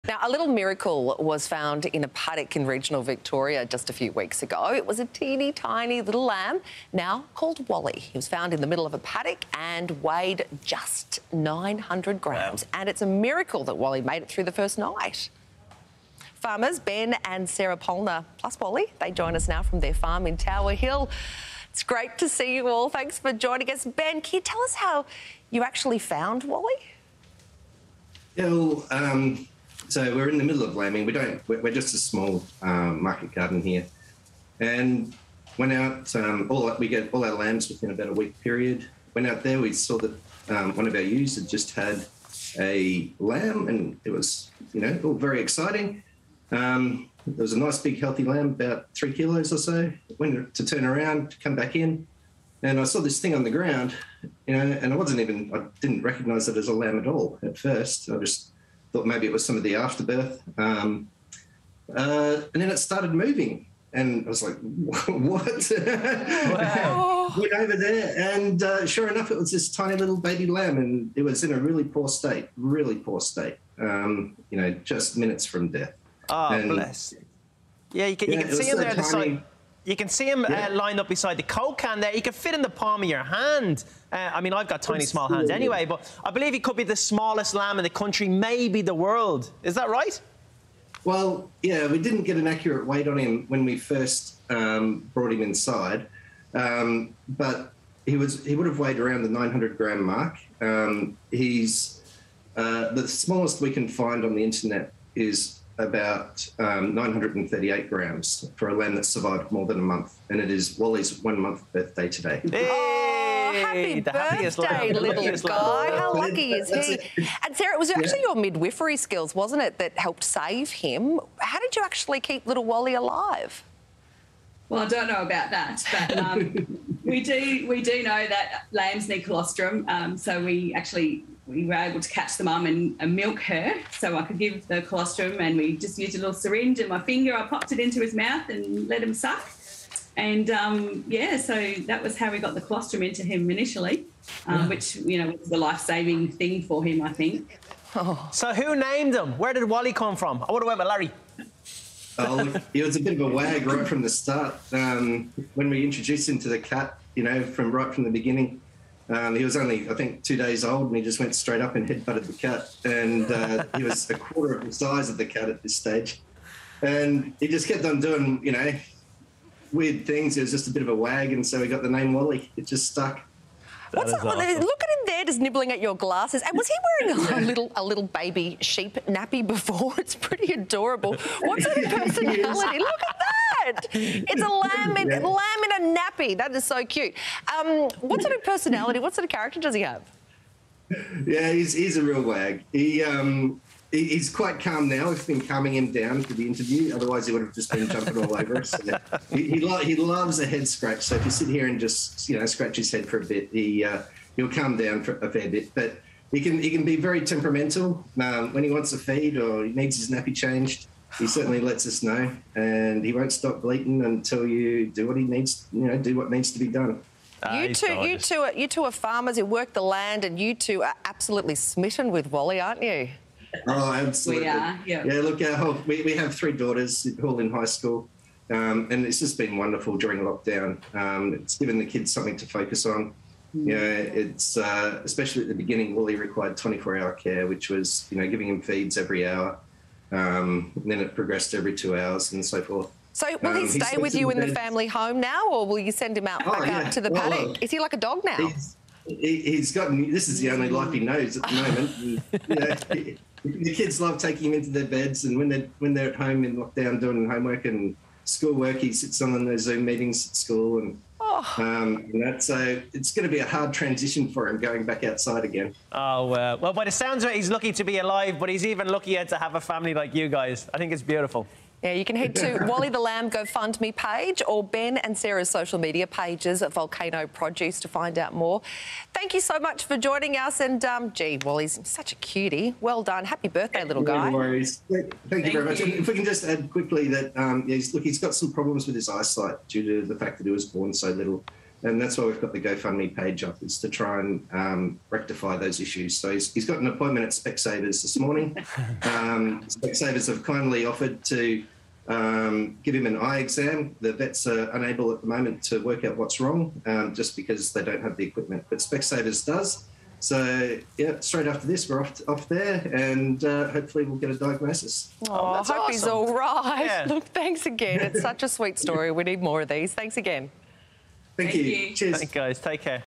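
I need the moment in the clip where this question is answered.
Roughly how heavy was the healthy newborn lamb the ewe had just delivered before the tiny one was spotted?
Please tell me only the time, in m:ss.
0:48.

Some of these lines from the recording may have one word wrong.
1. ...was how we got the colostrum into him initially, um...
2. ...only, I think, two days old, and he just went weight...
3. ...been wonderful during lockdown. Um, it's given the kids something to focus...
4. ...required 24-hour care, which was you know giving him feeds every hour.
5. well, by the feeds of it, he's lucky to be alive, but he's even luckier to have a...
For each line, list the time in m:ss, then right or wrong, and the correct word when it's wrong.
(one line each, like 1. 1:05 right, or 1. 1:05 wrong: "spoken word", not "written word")
1. 2:22 right
2. 2:39 wrong: "straight", not "weight"
3. 3:49 right
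4. 3:56 right
5. 4:26 wrong: "sounds", not "feeds".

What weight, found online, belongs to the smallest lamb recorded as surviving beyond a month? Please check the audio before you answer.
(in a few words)
938 grams.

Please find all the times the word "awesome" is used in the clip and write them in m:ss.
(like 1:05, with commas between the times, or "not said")
2:54, 5:15.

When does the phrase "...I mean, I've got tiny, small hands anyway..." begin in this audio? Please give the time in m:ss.
1:24.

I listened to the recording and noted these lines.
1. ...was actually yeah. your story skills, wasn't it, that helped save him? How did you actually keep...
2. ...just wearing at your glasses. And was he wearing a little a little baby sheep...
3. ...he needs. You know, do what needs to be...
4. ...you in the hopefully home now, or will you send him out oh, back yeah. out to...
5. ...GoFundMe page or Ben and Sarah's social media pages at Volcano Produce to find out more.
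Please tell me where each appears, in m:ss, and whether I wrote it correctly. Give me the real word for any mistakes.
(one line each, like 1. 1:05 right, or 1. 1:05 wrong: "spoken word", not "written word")
1. 1:57 wrong: "midwifery", not "story"
2. 2:55 wrong: "nibbling", not "wearing"
3. 3:35 right
4. 4:04 wrong: "family", not "hopefully"
5. 4:33 right.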